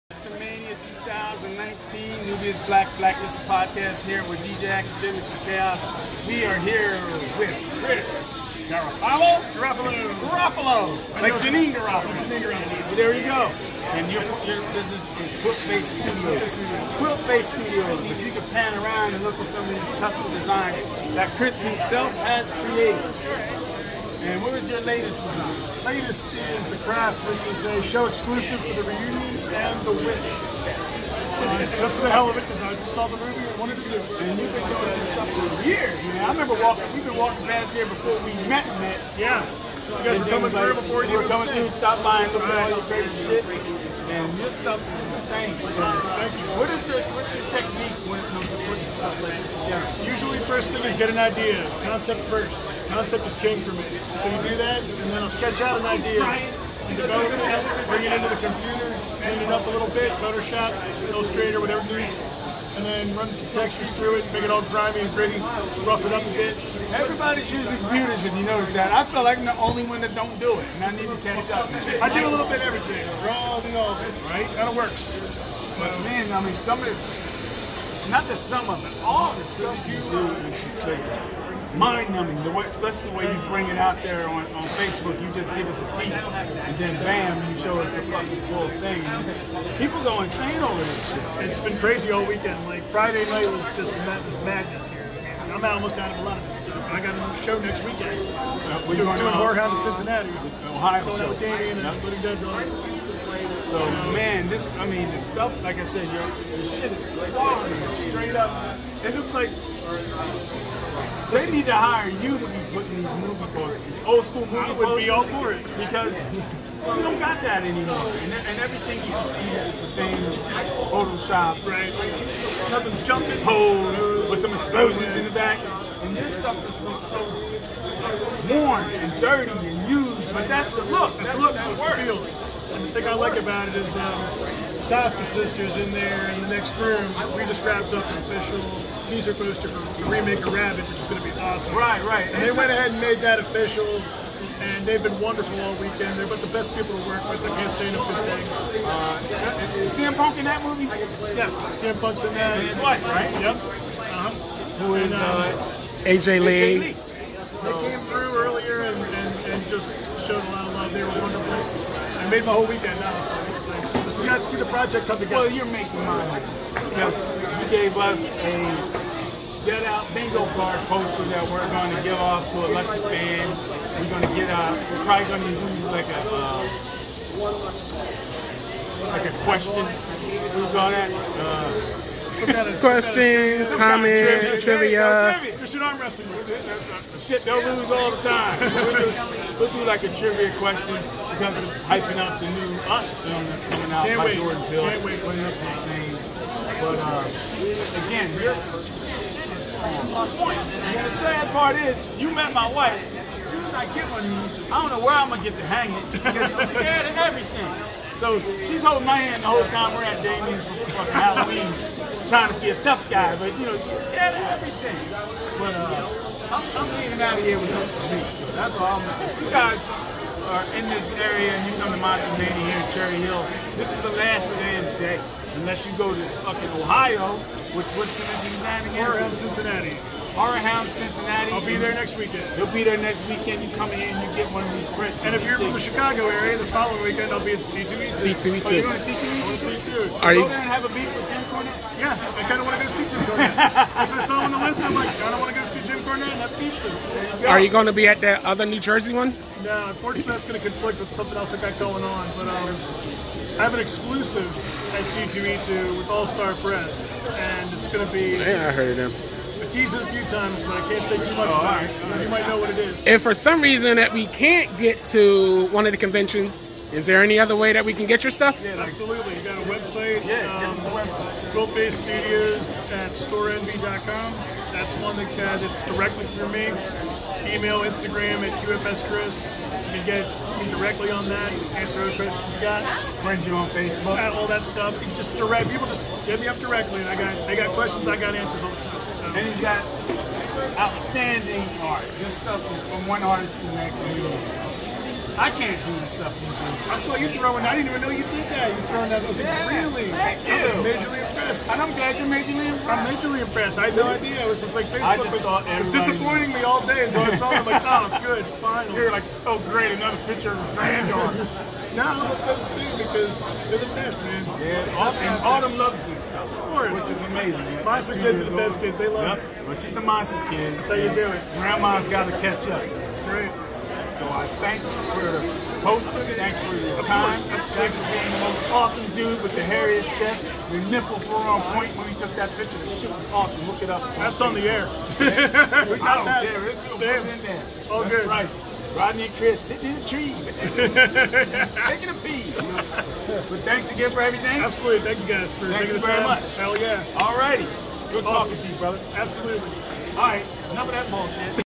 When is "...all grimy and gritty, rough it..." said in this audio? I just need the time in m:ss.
1:04.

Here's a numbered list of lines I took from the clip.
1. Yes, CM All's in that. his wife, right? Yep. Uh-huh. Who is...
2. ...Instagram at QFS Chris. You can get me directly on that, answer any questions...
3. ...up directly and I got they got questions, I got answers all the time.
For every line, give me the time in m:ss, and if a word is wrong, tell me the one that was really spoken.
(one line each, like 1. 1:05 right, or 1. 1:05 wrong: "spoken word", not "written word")
1. 2:30 wrong: "Punk", not "All"
2. 4:37 right
3. 4:46 right.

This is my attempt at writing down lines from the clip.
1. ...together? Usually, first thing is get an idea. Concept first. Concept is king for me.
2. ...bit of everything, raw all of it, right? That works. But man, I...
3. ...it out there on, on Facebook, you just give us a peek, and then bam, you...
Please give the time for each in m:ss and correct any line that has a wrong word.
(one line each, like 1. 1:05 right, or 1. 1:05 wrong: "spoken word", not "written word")
1. 0:49 right
2. 1:12 right
3. 1:23 right.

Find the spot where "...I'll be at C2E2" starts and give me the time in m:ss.
3:57.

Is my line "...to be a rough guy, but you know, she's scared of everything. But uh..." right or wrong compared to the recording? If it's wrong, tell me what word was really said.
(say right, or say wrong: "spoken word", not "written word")
wrong: "tough", not "rough".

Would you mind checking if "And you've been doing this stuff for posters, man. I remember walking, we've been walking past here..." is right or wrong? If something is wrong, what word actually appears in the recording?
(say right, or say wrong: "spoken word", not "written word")
wrong: "years", not "posters".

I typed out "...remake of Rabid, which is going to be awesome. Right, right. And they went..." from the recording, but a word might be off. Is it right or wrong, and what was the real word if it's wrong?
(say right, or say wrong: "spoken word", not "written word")
right.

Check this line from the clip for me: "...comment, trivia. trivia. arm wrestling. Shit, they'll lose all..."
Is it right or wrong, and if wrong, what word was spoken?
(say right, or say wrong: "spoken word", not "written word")
right.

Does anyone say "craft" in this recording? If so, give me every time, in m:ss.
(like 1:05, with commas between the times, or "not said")
0:26.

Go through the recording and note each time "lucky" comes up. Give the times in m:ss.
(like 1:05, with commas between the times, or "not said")
2:52.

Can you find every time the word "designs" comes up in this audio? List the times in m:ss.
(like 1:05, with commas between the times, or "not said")
0:20, 0:25.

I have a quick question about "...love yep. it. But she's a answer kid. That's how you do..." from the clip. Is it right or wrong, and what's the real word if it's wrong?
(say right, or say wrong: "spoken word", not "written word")
wrong: "monster", not "answer".